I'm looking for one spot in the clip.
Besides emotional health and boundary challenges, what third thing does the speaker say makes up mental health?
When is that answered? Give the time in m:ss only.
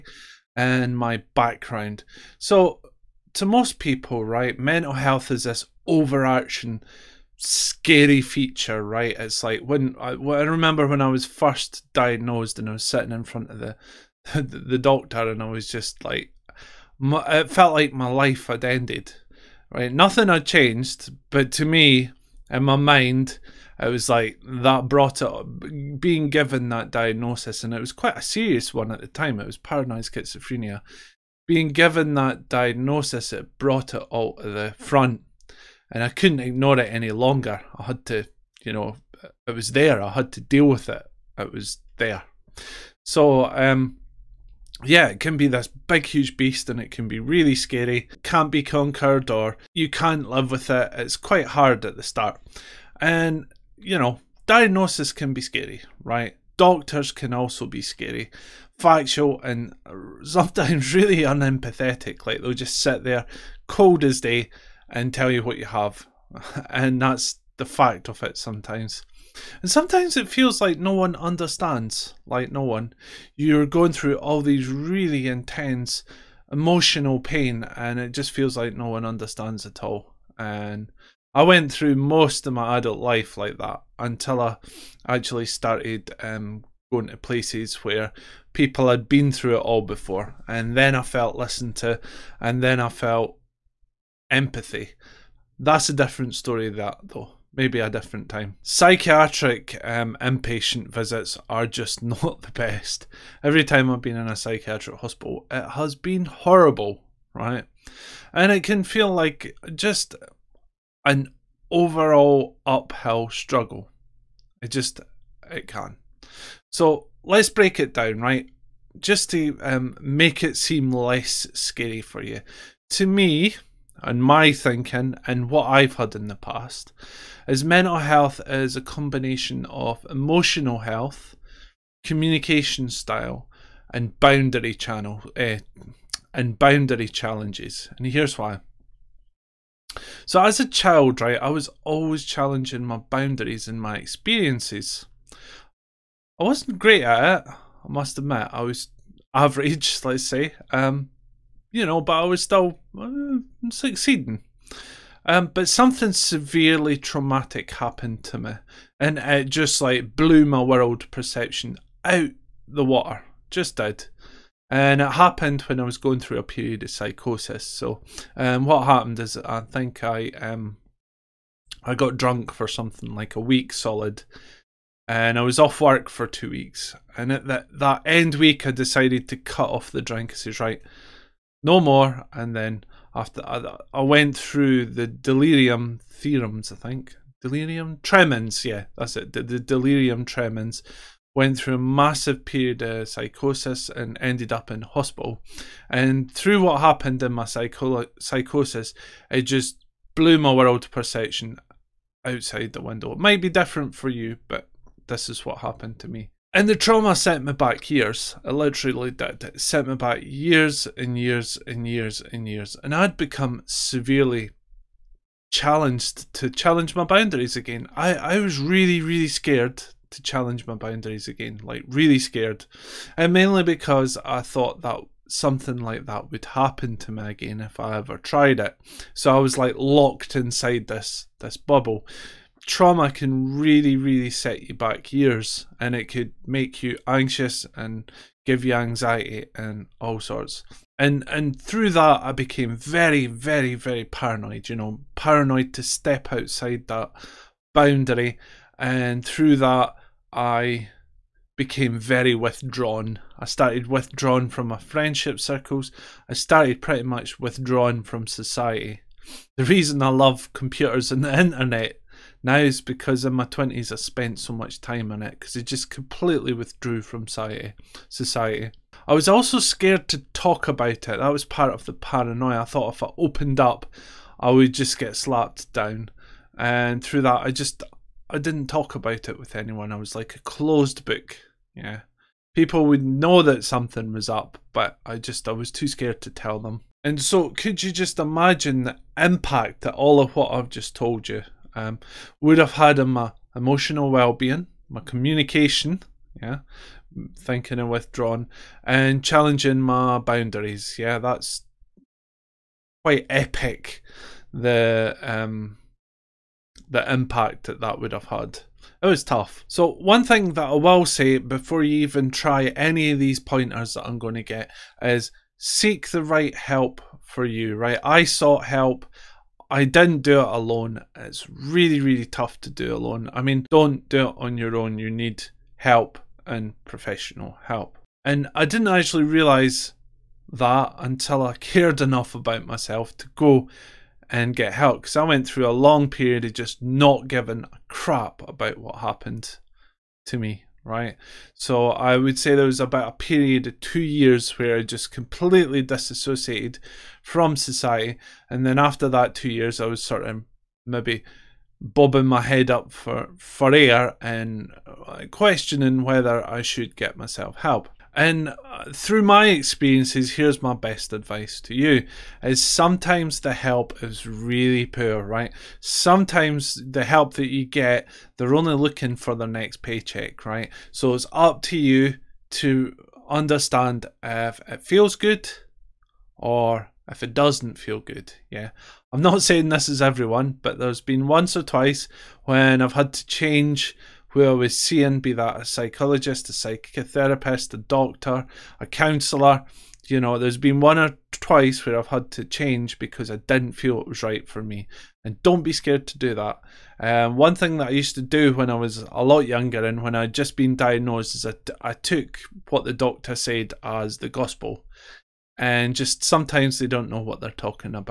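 2:12.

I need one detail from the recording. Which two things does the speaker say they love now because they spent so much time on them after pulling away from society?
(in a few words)
computers and the internet.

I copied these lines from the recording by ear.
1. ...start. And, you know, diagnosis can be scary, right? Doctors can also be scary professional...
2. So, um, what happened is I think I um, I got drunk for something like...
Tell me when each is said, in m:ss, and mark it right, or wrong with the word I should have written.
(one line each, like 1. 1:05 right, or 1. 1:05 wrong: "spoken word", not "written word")
1. 0:52 wrong: "factual", not "professional"
2. 2:47 right.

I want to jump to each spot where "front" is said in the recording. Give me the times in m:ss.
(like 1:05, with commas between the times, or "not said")
0:13, 0:34.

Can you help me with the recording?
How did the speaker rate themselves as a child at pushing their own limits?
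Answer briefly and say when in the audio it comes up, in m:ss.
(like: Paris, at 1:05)
average, at 2:29.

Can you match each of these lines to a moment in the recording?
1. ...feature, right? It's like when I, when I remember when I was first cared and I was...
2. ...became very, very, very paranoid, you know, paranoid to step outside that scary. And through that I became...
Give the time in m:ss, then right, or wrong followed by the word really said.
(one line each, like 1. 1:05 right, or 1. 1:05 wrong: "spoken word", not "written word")
1. 0:08 wrong: "diagnosed", not "cared"
2. 4:02 wrong: "boundary", not "scary".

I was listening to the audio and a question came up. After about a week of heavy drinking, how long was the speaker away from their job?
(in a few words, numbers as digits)
two weeks.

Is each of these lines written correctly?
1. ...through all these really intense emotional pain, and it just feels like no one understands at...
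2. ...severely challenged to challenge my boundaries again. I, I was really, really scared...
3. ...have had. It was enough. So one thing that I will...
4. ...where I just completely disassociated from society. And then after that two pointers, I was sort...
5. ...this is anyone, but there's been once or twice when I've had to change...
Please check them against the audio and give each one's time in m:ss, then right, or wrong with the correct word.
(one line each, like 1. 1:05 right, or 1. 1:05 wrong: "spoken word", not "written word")
1. 1:13 right
2. 3:33 right
3. 5:08 wrong: "tough", not "enough"
4. 5:44 wrong: "years", not "pointers"
5. 6:19 wrong: "everyone", not "anyone".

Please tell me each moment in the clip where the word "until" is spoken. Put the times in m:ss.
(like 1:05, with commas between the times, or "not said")
1:23, 5:30.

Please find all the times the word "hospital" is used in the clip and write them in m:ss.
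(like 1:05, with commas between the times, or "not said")
1:44, 3:14.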